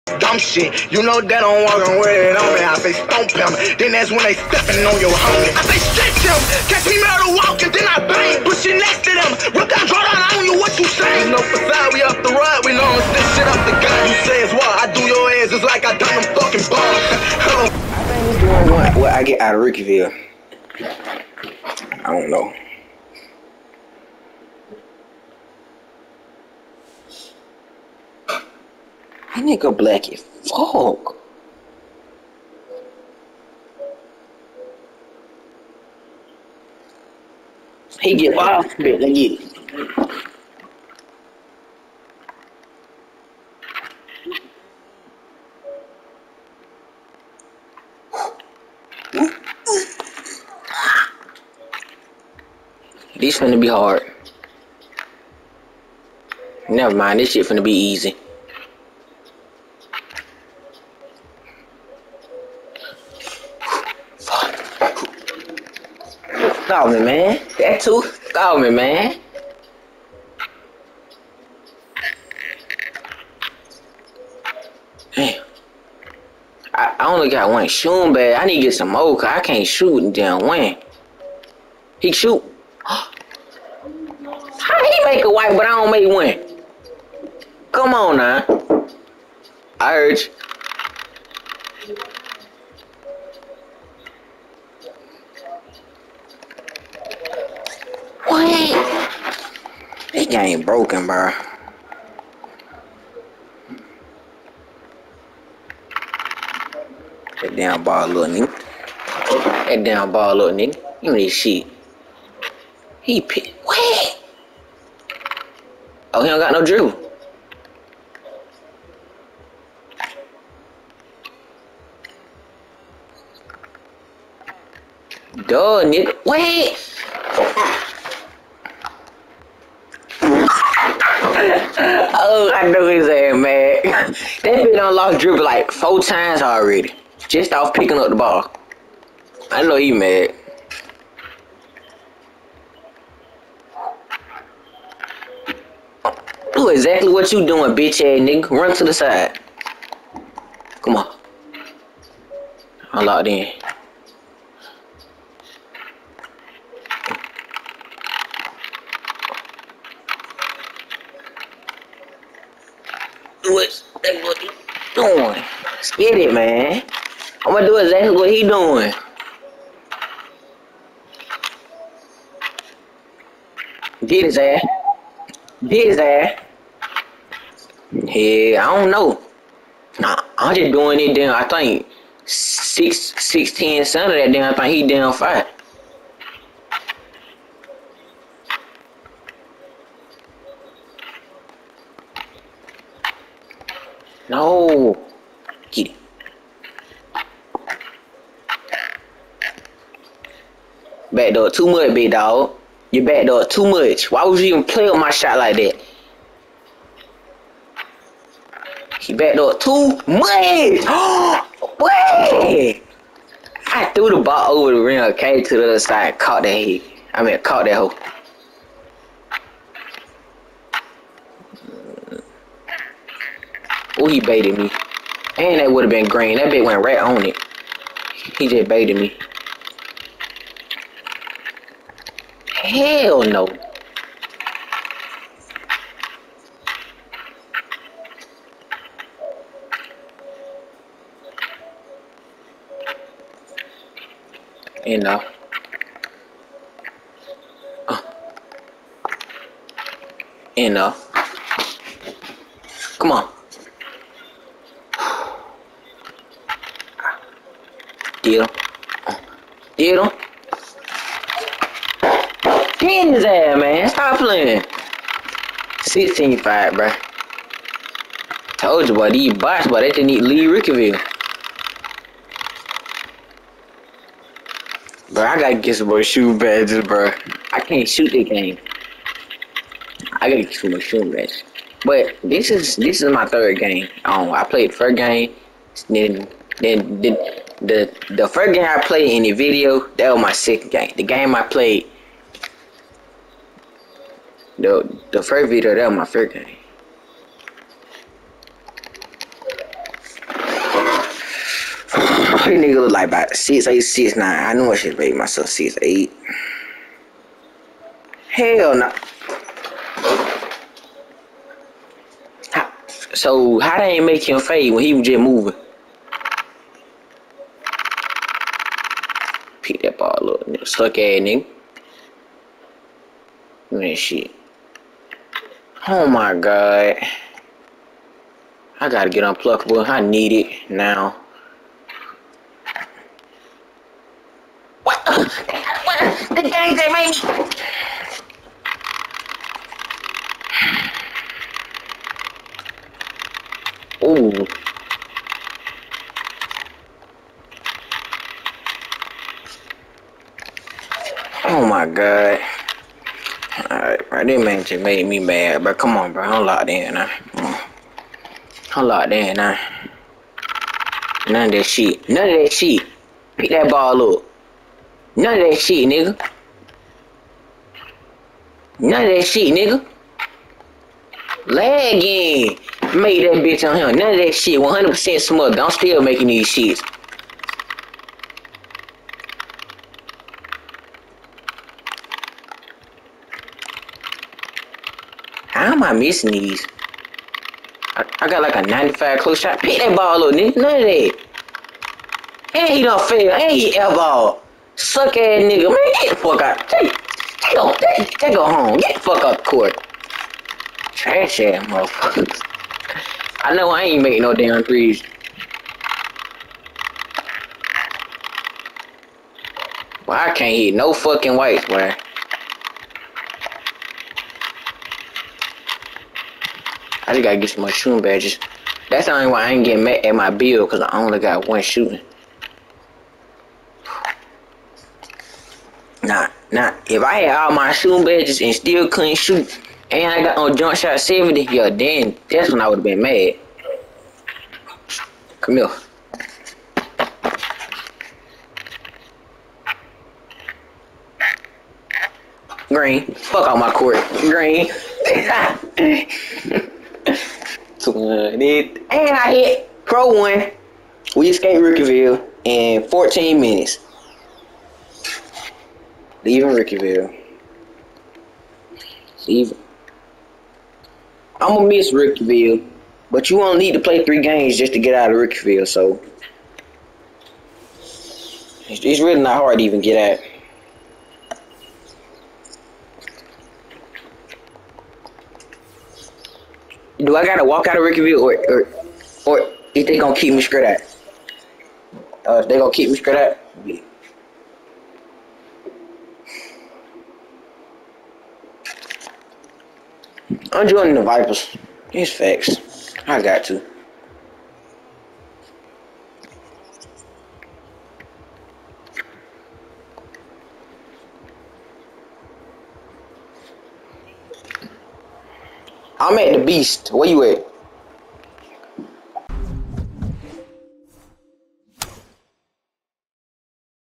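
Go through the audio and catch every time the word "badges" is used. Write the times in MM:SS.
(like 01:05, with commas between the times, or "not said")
04:36, 04:41, 06:58, 07:08.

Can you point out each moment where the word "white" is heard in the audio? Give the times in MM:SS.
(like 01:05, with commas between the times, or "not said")
01:25, 06:51.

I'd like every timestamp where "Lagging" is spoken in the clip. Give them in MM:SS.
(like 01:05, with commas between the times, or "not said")
06:11.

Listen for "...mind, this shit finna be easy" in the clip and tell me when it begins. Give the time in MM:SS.
00:56.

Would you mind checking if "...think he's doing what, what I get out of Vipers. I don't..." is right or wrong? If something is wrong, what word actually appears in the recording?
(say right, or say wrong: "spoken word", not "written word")
wrong: "Rookieville", not "Vipers".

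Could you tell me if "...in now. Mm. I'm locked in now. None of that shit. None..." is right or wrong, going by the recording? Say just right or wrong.
right.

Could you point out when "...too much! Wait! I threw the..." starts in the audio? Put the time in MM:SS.
03:29.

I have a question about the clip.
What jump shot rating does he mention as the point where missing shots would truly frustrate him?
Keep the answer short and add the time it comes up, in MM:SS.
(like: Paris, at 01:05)
70, at 07:11.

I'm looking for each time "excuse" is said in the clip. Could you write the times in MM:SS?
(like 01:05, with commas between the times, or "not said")
not said.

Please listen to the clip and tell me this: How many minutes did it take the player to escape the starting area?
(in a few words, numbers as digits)
14.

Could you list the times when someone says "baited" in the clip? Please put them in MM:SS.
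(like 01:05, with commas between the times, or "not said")
03:44, 03:48.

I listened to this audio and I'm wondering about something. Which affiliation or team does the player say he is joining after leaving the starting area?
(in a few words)
Vipers.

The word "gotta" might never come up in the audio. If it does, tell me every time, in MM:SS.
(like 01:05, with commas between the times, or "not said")
04:35, 04:40, 05:28, 06:57, 07:57.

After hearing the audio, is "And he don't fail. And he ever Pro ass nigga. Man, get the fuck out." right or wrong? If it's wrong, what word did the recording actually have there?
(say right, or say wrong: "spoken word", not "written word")
wrong: "Suck", not "Pro".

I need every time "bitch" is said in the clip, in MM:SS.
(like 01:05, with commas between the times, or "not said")
02:27, 06:13.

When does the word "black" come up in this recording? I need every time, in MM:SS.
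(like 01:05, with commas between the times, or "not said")
00:29.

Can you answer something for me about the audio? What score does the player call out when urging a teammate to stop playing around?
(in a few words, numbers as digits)
16 5.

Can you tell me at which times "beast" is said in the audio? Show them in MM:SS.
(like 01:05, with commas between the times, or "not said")
08:26.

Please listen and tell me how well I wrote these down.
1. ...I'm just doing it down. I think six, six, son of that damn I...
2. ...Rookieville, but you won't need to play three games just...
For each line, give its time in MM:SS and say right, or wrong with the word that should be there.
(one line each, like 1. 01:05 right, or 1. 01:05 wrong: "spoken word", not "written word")
1. 03:00 right
2. 07:41 right.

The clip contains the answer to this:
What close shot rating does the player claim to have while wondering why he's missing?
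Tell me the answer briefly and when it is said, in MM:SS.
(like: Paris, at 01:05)
95, at 06:28.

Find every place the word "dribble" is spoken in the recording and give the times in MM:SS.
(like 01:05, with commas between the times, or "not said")
01:56, 02:15.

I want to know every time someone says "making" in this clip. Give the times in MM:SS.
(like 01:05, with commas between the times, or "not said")
06:16, 06:44.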